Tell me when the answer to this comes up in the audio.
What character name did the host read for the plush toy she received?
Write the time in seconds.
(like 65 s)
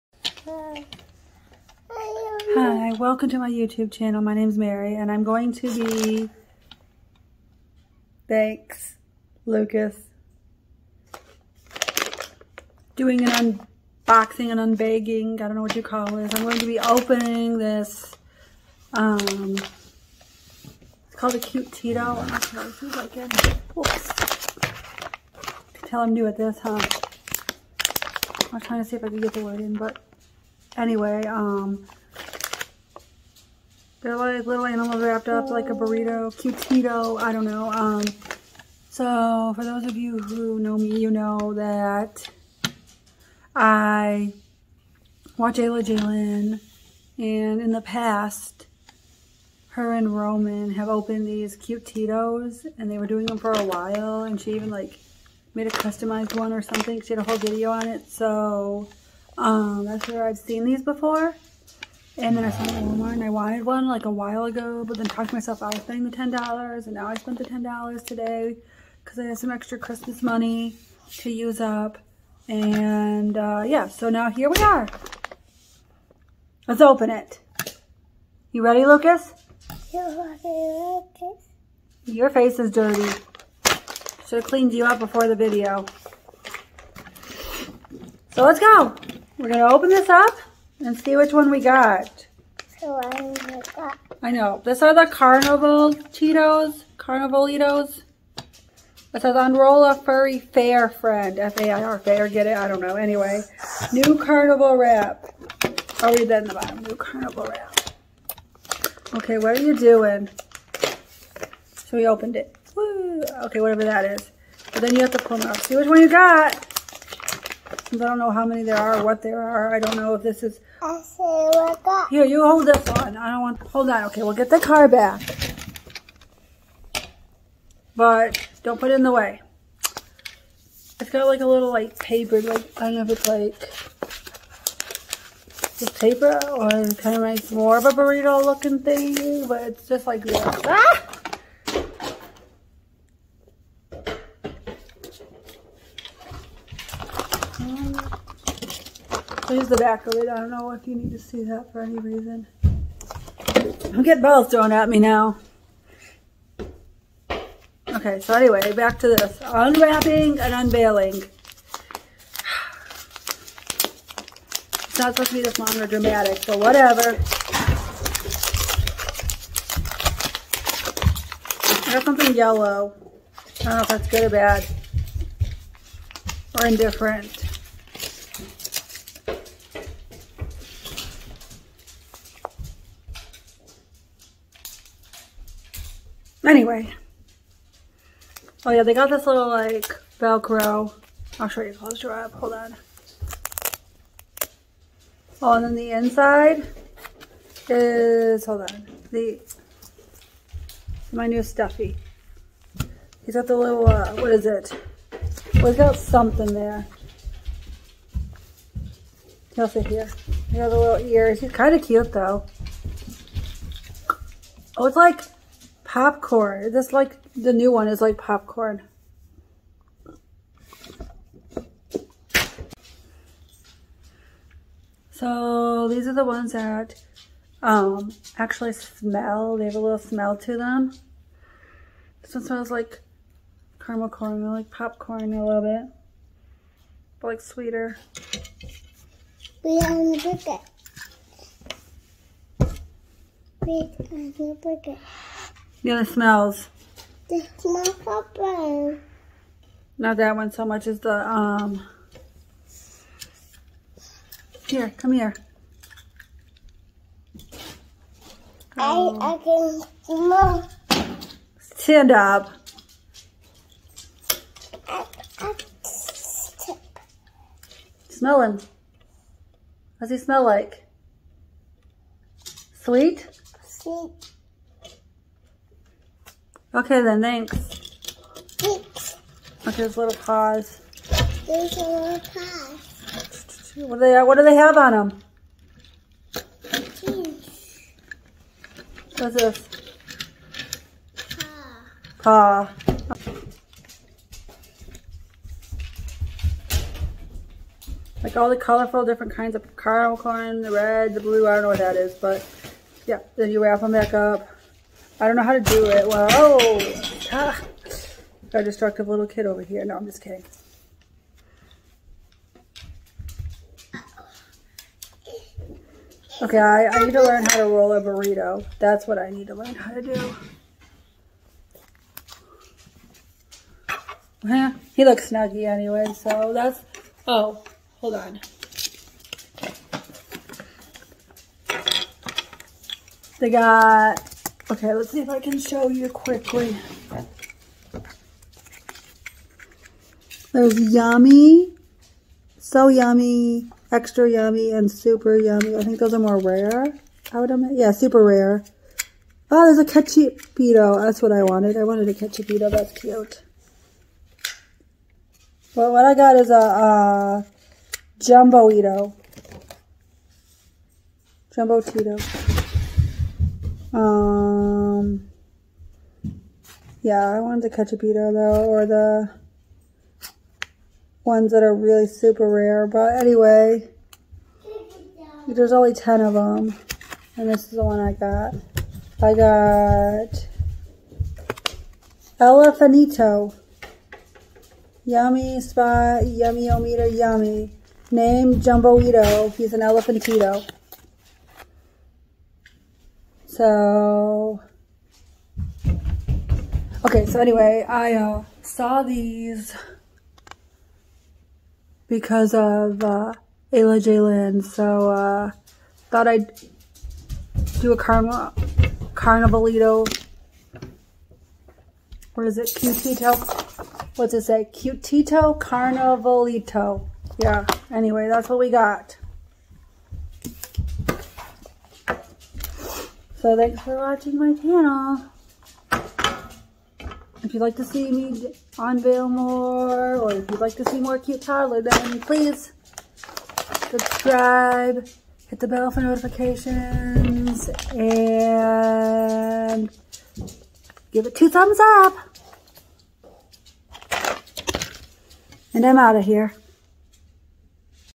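382 s.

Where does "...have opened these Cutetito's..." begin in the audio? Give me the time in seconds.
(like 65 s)
50 s.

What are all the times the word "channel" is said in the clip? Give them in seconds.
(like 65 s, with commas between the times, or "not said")
3 s, 424 s.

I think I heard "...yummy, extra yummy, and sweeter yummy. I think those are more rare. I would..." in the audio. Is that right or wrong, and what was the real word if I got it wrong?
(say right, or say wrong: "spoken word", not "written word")
wrong: "super", not "sweeter".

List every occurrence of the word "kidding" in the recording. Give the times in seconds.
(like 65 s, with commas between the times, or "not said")
310 s.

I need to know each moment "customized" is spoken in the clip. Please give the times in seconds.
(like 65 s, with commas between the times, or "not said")
55 s.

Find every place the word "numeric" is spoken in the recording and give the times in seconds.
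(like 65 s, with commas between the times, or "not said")
not said.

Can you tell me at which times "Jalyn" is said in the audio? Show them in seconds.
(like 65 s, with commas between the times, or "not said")
45 s, 404 s.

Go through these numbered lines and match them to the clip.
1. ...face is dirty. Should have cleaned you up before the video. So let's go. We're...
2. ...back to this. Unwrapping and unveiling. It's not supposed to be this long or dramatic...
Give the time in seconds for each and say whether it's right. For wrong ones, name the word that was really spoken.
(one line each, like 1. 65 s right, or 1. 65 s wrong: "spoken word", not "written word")
1. 82 s right
2. 158 s right.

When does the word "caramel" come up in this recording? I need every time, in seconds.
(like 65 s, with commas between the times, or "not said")
233 s, 299 s.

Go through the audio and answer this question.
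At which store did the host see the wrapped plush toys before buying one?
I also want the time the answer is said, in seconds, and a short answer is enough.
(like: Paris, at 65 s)
Walmart, at 62 s.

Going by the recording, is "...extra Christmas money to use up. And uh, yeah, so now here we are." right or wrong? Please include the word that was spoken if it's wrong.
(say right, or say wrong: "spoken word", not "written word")
right.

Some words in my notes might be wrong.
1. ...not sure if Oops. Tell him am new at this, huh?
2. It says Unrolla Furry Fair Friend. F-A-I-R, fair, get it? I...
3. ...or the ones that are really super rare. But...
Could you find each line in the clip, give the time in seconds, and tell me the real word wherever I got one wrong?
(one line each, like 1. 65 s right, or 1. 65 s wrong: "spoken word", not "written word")
1. 22 s right
2. 98 s right
3. 368 s right.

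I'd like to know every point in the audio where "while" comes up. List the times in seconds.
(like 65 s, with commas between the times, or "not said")
53 s, 64 s.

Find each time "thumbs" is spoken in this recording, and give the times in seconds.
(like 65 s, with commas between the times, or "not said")
441 s.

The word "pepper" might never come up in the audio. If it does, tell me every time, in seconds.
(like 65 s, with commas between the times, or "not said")
248 s.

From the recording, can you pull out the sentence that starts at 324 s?
Yeah, he looks snuggy anyway, so that's...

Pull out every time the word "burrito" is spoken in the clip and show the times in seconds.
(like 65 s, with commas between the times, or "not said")
35 s, 137 s, 318 s.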